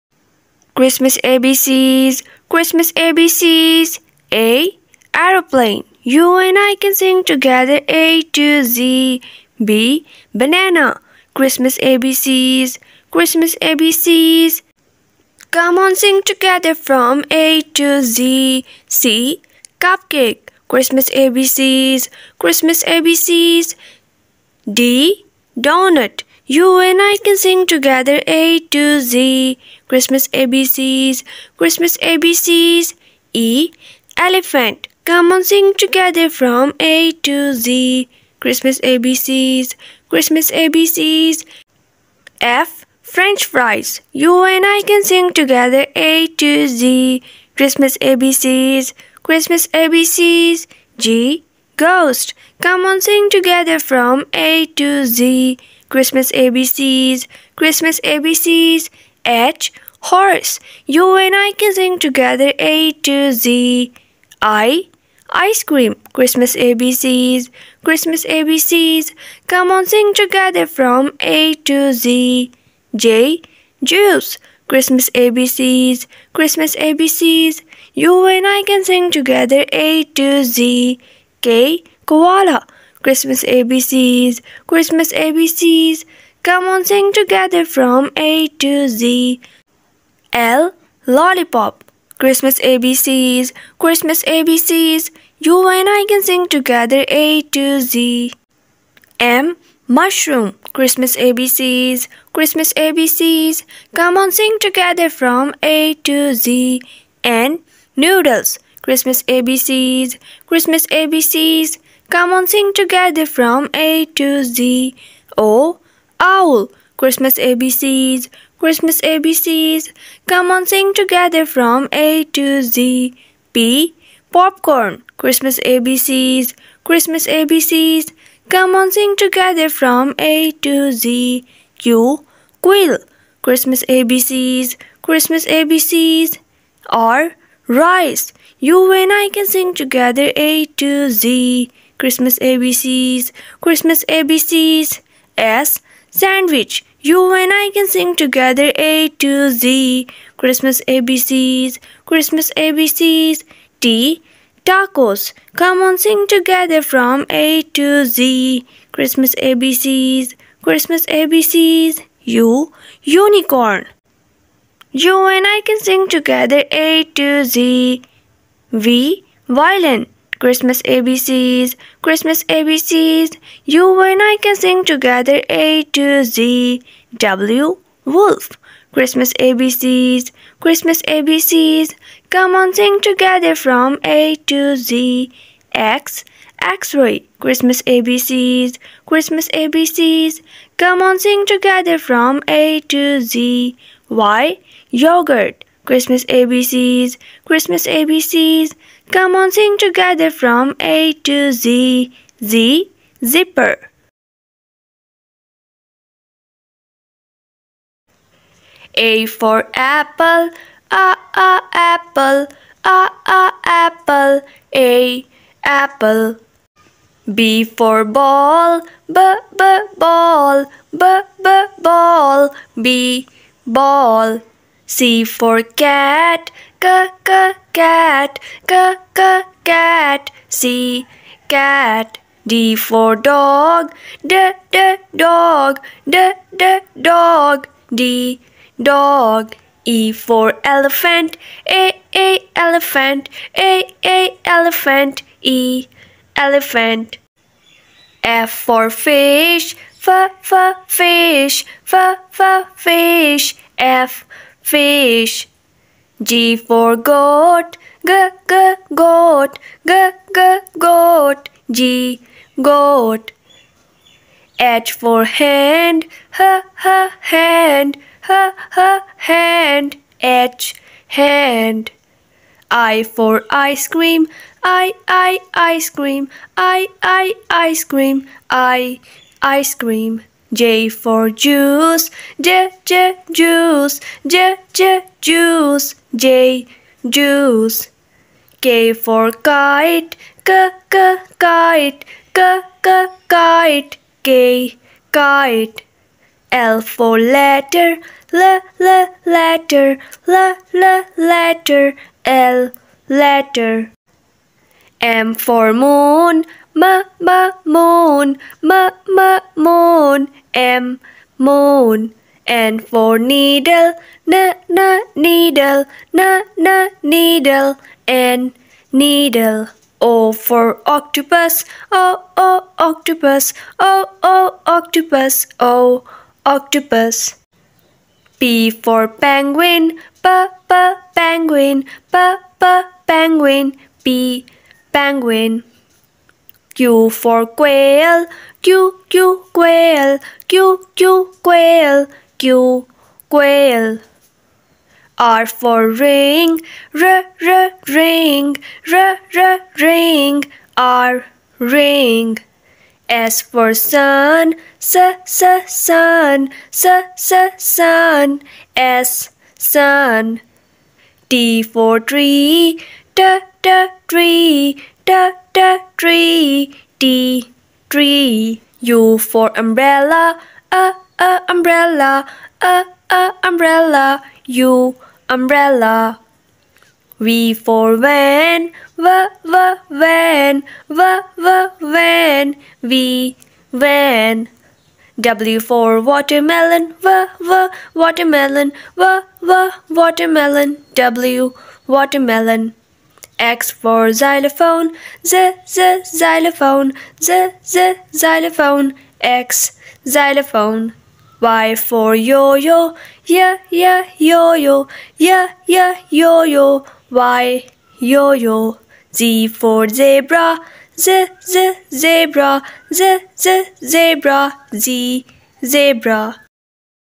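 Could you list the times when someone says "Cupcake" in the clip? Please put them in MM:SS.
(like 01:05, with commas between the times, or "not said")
00:19.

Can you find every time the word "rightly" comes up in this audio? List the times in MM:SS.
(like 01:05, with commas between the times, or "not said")
not said.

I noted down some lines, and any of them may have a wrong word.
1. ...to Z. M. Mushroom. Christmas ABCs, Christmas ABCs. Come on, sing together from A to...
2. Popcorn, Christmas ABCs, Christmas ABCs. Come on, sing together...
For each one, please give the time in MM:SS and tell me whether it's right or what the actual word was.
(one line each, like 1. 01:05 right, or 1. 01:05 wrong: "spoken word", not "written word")
1. 01:37 right
2. 02:04 right.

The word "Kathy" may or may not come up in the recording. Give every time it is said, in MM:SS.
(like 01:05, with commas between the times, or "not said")
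not said.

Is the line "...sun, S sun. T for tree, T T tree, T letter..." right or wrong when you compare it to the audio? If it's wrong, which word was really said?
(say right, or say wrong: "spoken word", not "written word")
right.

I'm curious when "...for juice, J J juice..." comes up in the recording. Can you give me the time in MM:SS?
04:40.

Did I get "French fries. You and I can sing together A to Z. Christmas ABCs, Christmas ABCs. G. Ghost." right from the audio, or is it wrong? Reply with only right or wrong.
right.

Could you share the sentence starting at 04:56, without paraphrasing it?
L for letter, L L letter, L L letter, L letter.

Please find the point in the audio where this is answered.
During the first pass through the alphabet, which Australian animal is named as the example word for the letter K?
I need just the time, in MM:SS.
01:22.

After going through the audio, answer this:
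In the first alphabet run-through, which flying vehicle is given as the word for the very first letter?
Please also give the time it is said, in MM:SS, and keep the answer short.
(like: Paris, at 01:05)
Aeroplane, at 00:05.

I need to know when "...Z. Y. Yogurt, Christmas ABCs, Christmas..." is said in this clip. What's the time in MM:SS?
03:13.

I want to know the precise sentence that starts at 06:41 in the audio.
Y for yo-yo, yeah, yeah, yo-yo, yeah, yeah, yo-yo, Y, yo-yo.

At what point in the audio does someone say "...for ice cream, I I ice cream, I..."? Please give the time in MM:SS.
04:33.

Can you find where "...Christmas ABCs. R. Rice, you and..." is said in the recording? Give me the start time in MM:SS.
02:15.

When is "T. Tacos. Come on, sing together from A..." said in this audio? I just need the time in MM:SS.
02:33.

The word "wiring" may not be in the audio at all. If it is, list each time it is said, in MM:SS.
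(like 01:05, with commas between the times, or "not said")
not said.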